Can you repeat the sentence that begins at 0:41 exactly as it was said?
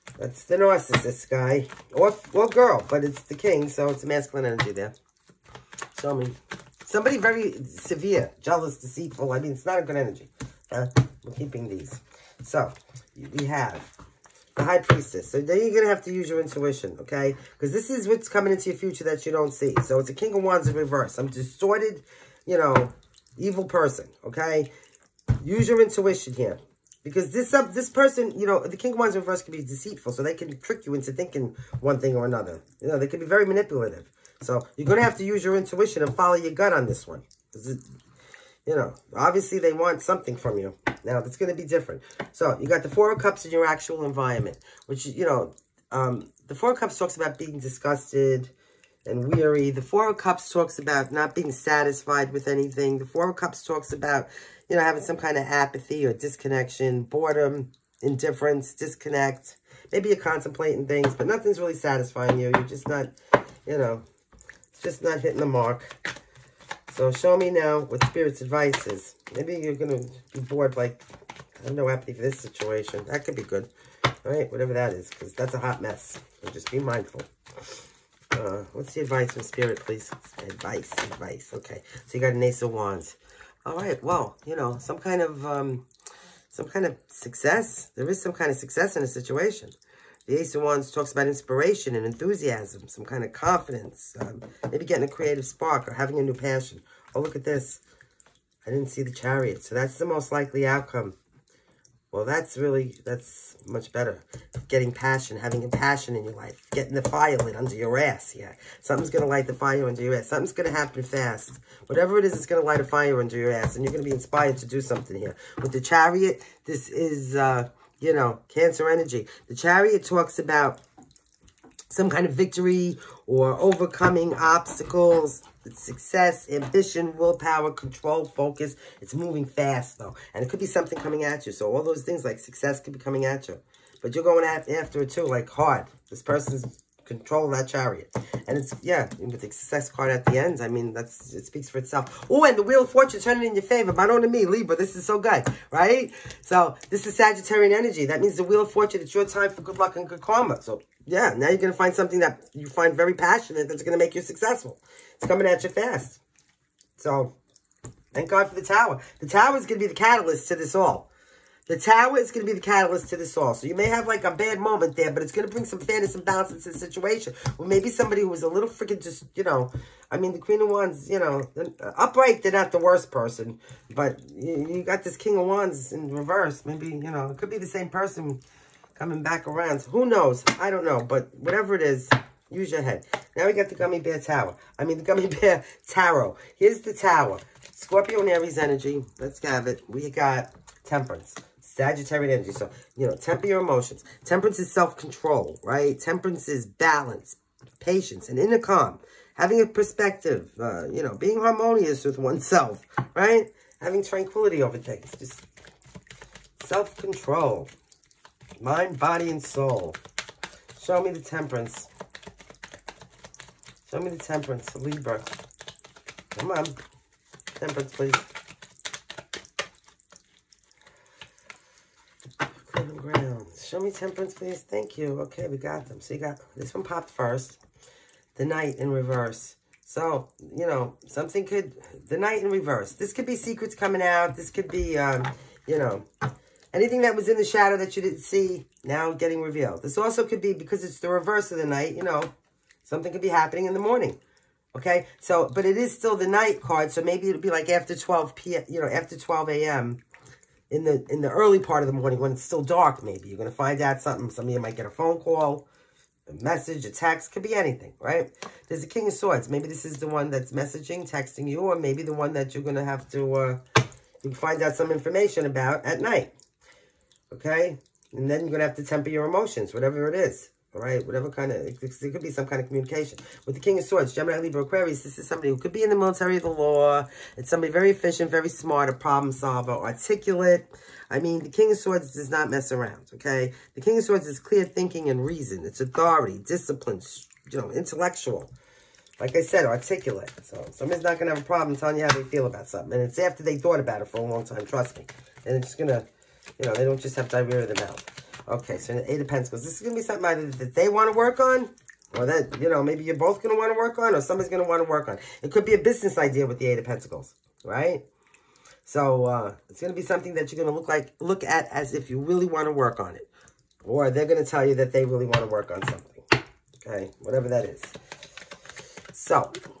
Now, that's going to be different.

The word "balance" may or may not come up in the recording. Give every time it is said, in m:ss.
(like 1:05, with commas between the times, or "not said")
2:46, 3:16.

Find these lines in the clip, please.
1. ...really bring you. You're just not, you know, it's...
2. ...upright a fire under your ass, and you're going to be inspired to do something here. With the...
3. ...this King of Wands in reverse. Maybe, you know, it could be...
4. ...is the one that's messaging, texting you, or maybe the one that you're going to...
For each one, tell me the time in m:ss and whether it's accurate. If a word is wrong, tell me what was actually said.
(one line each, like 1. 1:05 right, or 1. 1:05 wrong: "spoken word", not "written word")
1. 1:01 wrong: "satisfying", not "bring"
2. 1:52 wrong: "light", not "upright"
3. 2:55 right
4. 4:19 right.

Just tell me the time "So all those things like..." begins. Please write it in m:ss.
2:11.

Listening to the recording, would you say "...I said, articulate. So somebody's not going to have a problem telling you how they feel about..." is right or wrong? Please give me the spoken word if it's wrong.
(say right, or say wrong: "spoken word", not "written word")
right.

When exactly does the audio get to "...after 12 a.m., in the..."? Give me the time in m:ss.
4:08.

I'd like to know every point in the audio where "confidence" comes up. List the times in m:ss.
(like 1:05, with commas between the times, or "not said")
1:33.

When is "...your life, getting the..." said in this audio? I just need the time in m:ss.
1:46.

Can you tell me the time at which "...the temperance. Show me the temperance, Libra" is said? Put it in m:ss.
3:31.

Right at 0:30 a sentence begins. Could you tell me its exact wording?
So they can trick you into thinking one thing or another.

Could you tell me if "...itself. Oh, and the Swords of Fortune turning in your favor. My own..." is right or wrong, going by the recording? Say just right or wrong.
wrong.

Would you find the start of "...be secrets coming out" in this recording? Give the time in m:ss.
3:53.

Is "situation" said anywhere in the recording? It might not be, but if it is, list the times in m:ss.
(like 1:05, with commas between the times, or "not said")
1:12, 1:29, 2:46.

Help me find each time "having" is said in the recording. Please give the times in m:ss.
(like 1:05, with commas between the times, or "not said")
0:54, 1:35, 1:45, 3:19, 3:23.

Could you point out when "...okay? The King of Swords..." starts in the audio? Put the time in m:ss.
4:43.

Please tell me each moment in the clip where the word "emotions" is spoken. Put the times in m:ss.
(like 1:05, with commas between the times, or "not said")
3:13, 4:29.